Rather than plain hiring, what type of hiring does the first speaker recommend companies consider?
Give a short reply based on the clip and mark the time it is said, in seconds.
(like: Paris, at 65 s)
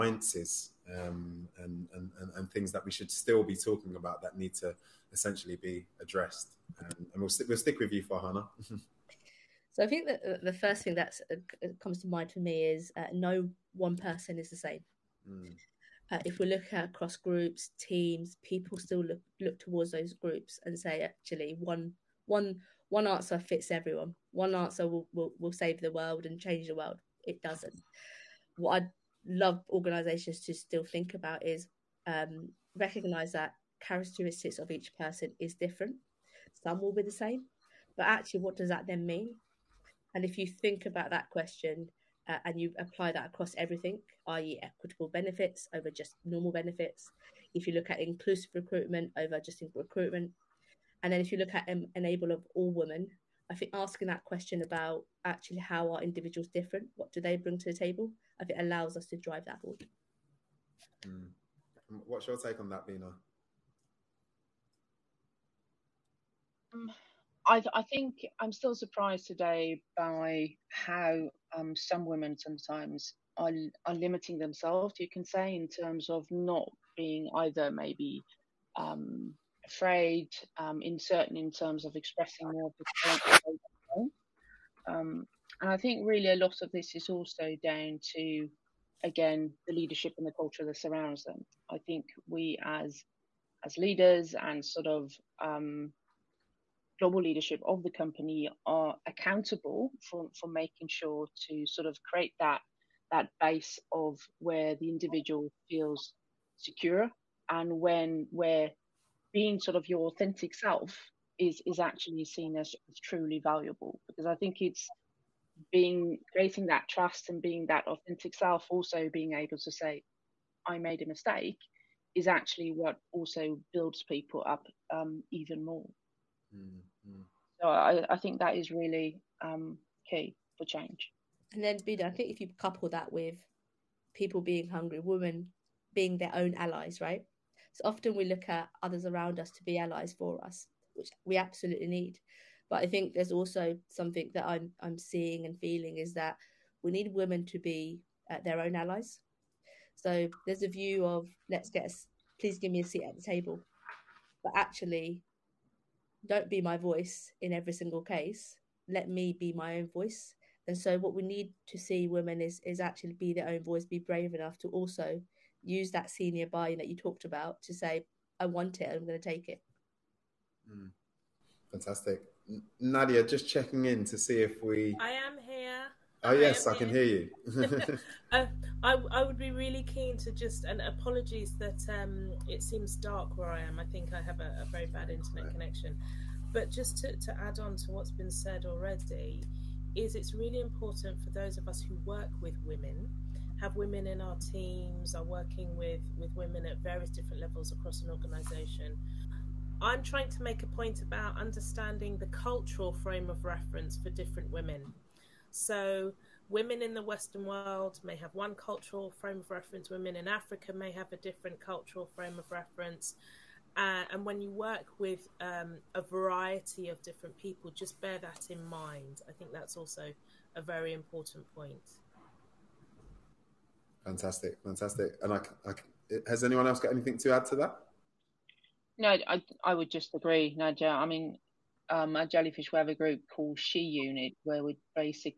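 Inclusive recruitment, at 47 s.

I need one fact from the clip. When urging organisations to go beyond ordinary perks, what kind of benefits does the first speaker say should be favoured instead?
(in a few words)
Equitable benefits.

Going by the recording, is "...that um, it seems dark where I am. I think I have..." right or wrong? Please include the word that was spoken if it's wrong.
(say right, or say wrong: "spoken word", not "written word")
right.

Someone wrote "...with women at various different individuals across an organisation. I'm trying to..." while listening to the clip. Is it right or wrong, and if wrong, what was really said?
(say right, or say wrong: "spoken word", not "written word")
wrong: "levels", not "individuals".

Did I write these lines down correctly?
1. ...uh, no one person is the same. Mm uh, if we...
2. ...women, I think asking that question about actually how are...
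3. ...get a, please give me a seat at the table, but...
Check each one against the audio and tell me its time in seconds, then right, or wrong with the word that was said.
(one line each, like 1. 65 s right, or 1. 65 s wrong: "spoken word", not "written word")
1. 12 s right
2. 52 s right
3. 151 s right.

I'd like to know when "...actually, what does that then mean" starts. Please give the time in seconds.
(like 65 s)
38 s.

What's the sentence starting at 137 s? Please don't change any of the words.
So often we look at others around us to be allies for us, which we absolutely need.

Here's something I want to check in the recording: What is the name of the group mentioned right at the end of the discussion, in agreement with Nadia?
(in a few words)
She Unit.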